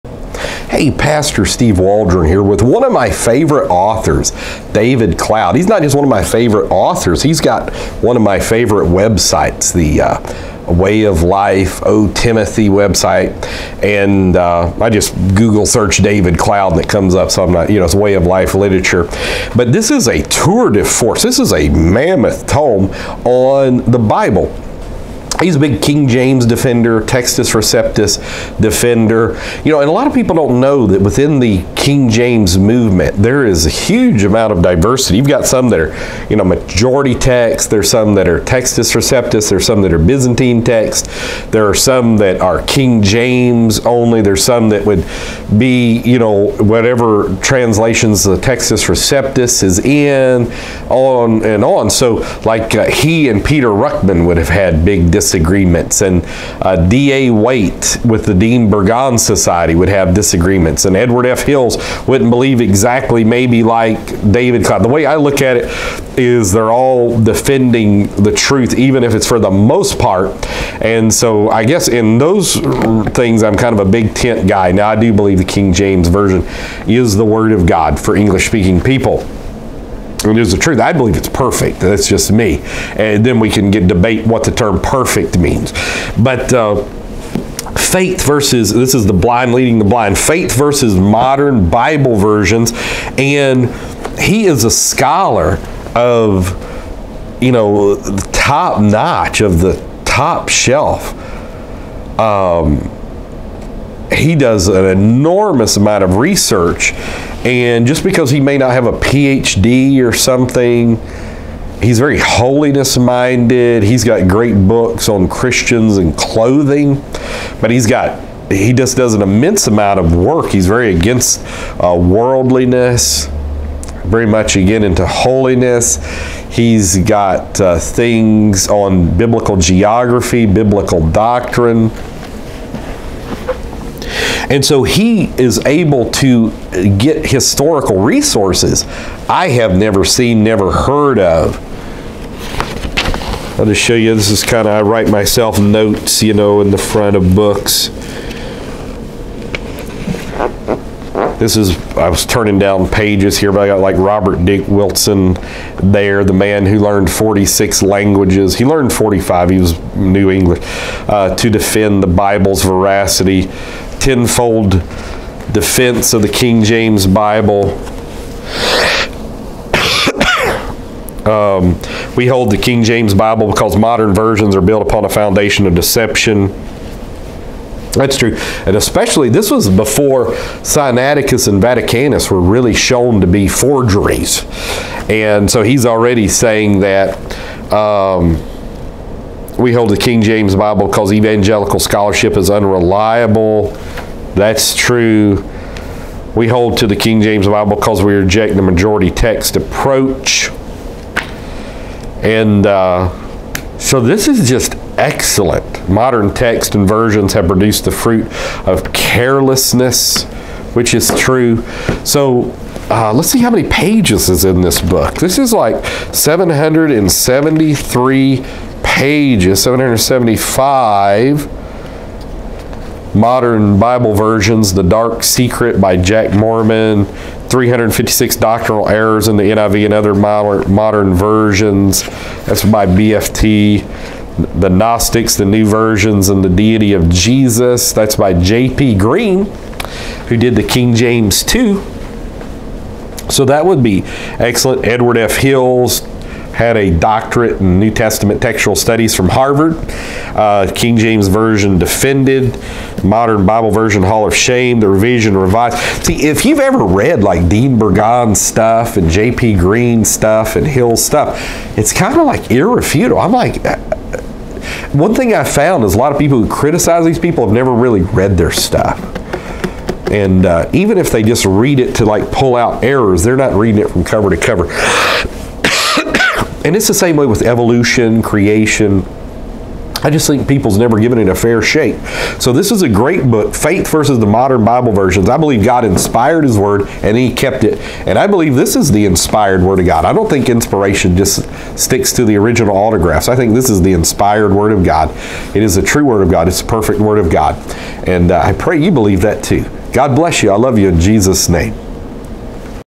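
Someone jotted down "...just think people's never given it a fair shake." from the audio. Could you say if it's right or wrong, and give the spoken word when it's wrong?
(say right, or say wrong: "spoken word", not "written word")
right.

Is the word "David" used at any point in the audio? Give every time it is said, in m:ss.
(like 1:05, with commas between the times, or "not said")
0:04, 0:15, 1:04.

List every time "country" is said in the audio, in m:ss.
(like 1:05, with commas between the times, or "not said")
not said.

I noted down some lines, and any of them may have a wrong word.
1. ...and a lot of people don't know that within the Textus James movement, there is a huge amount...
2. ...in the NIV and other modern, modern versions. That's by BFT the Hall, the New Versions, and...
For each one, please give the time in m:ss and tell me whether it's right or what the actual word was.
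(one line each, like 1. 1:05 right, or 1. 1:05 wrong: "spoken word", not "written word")
1. 0:29 wrong: "King", not "Textus"
2. 3:49 wrong: "Gnostics", not "Hall".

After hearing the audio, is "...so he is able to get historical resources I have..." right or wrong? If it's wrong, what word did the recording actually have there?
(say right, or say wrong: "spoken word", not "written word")
right.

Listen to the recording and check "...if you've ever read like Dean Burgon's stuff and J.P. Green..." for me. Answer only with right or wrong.
right.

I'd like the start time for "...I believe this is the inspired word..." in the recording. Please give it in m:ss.
4:48.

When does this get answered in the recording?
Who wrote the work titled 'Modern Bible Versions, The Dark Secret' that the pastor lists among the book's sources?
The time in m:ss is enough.
3:45.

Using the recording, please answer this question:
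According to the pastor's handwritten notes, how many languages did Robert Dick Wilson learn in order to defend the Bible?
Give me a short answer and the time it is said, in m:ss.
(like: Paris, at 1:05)
46, at 2:37.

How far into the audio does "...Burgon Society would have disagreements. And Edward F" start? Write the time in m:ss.
0:58.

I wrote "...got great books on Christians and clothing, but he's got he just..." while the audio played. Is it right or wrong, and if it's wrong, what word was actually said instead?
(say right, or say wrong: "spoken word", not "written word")
right.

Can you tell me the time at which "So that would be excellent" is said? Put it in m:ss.
4:03.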